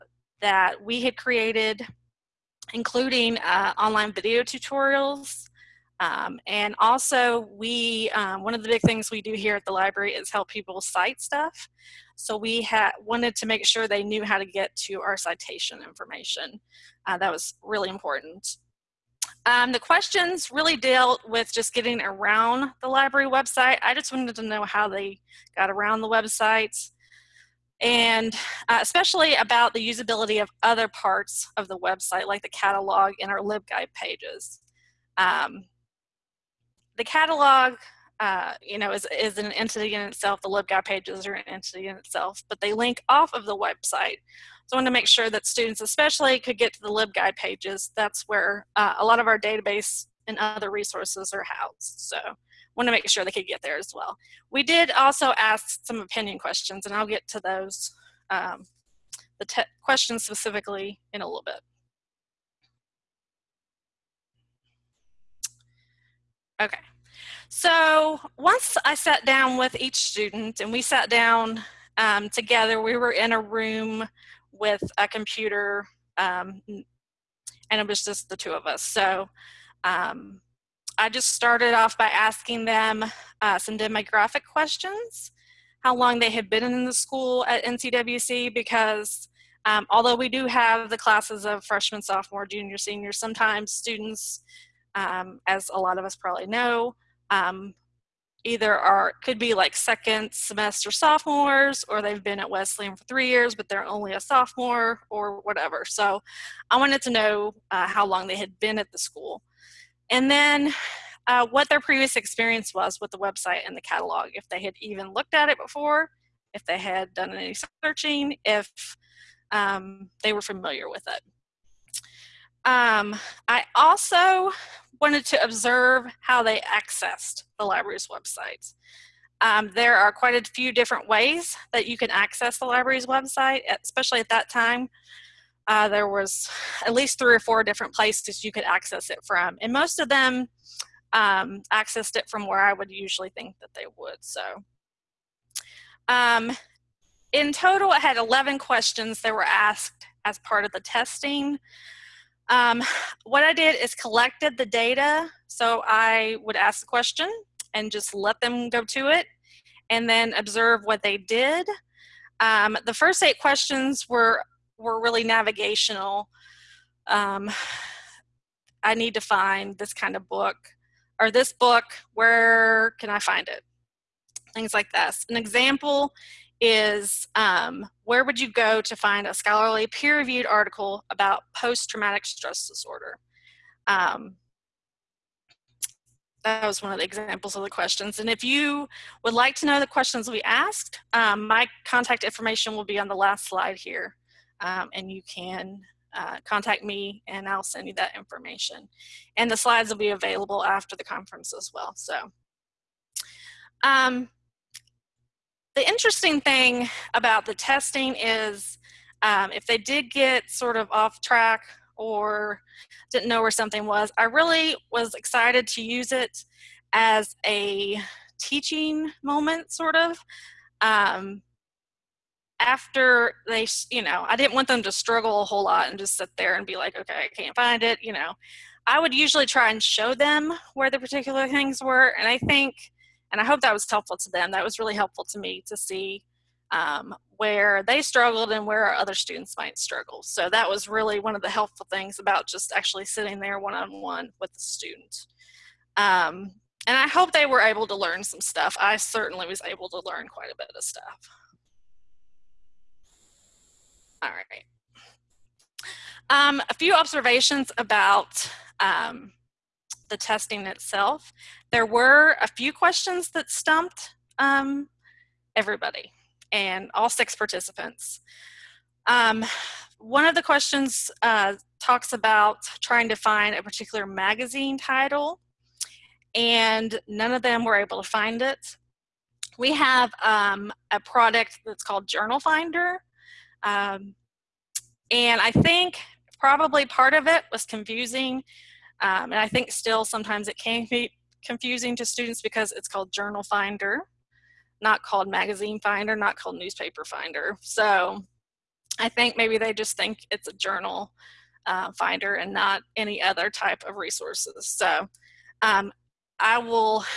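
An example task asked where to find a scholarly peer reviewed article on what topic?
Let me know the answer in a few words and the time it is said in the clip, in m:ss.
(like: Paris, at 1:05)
post traumatic stress disorder, at 3:01.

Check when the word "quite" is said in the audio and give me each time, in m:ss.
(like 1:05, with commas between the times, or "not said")
2:10, 4:10.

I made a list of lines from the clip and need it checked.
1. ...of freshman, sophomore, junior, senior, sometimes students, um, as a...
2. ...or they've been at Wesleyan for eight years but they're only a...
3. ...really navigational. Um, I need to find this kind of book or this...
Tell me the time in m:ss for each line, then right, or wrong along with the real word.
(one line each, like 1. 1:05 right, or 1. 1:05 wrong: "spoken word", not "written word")
1. 1:31 right
2. 1:41 wrong: "three", not "eight"
3. 2:44 right.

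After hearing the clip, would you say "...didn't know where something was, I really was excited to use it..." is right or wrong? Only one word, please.
right.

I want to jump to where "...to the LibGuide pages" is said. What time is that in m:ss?
0:46.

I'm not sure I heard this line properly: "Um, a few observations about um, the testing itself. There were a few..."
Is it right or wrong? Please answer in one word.
right.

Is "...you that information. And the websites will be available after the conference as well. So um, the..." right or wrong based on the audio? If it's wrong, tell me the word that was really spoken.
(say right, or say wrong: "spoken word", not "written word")
wrong: "slides", not "websites".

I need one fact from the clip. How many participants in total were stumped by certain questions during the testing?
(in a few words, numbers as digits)
6.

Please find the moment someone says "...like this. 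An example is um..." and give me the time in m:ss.
2:54.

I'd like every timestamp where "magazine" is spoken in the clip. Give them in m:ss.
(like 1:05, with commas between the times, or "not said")
4:34, 4:55.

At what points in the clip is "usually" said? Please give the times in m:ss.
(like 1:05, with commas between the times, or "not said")
2:22, 3:49.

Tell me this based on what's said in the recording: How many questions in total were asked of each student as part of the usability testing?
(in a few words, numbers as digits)
11.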